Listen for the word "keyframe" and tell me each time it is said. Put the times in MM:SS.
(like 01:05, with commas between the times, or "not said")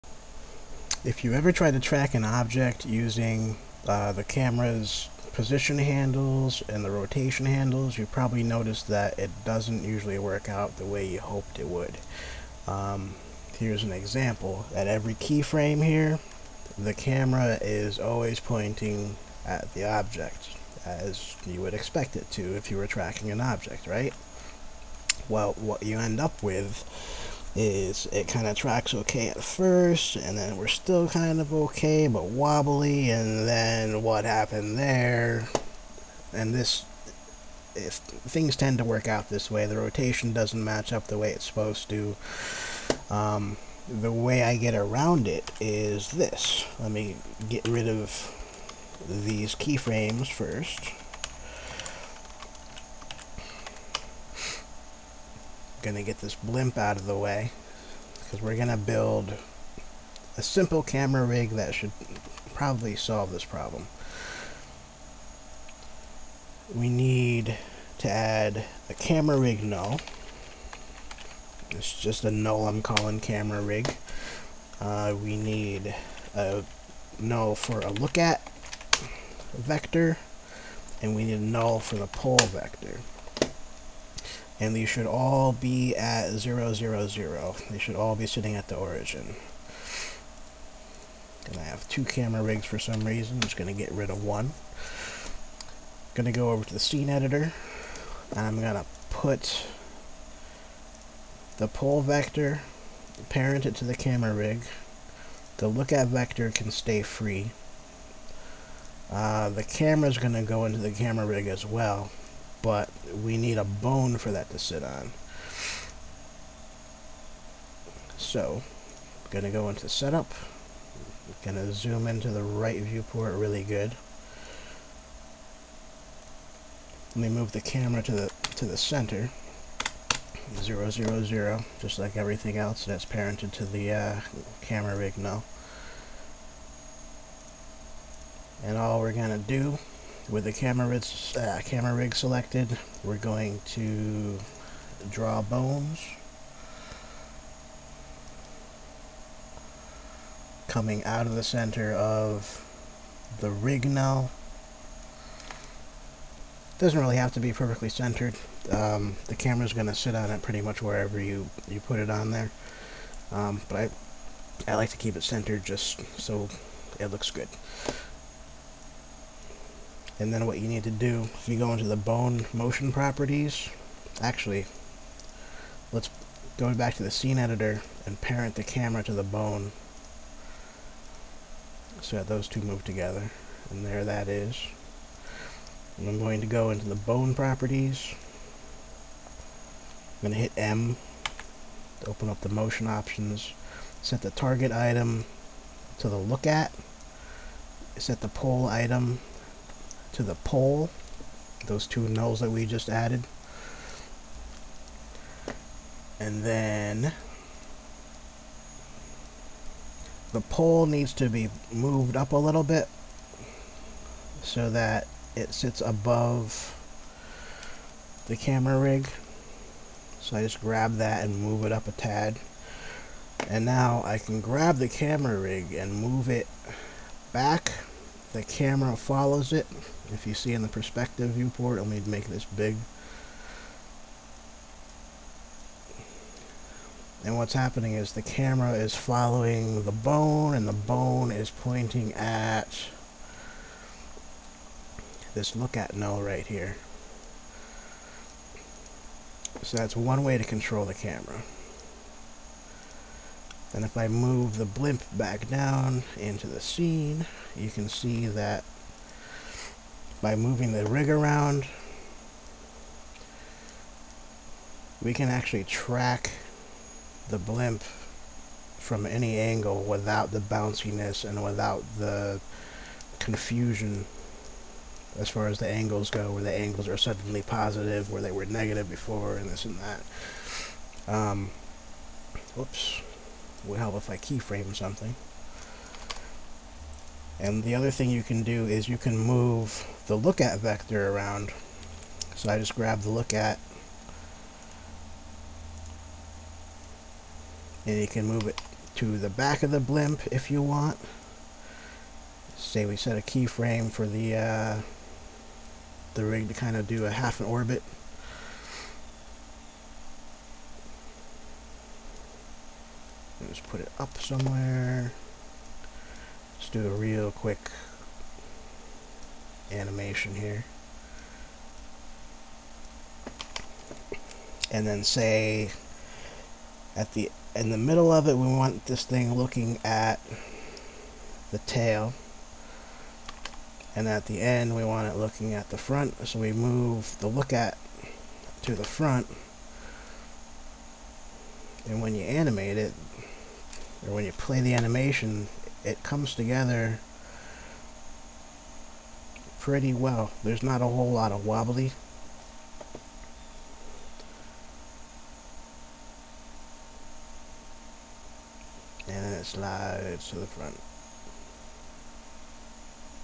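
00:15, 00:49, 04:44, 05:03.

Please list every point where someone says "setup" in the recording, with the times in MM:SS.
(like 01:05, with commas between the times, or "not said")
01:59.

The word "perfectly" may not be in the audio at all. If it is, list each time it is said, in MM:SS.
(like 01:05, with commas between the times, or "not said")
02:37.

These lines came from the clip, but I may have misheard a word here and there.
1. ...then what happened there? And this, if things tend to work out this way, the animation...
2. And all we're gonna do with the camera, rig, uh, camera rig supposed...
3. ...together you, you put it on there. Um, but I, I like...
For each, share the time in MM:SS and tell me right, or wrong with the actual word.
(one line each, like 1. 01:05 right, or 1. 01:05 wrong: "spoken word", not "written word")
1. 00:33 wrong: "rotation", not "animation"
2. 02:18 wrong: "selected", not "supposed"
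3. 02:40 wrong: "wherever", not "together".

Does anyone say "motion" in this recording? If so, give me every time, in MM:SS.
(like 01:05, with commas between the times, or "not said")
02:52, 03:12.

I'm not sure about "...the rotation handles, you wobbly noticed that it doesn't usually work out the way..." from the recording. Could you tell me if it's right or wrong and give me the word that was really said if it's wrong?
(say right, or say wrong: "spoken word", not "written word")
wrong: "probably", not "wobbly".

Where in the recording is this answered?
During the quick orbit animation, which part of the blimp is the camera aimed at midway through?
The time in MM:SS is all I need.
05:31.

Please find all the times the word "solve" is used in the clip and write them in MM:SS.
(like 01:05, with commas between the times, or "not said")
01:02.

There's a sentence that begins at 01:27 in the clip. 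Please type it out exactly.
They should all be sitting at the origin.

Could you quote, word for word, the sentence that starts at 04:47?
And the other thing you can do is you can move the look at vector around.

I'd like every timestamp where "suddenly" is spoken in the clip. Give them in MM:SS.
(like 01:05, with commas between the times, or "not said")
04:36.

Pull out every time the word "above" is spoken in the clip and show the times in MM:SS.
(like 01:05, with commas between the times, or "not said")
03:35.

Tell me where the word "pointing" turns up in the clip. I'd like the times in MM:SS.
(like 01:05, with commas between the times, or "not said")
00:18, 04:01.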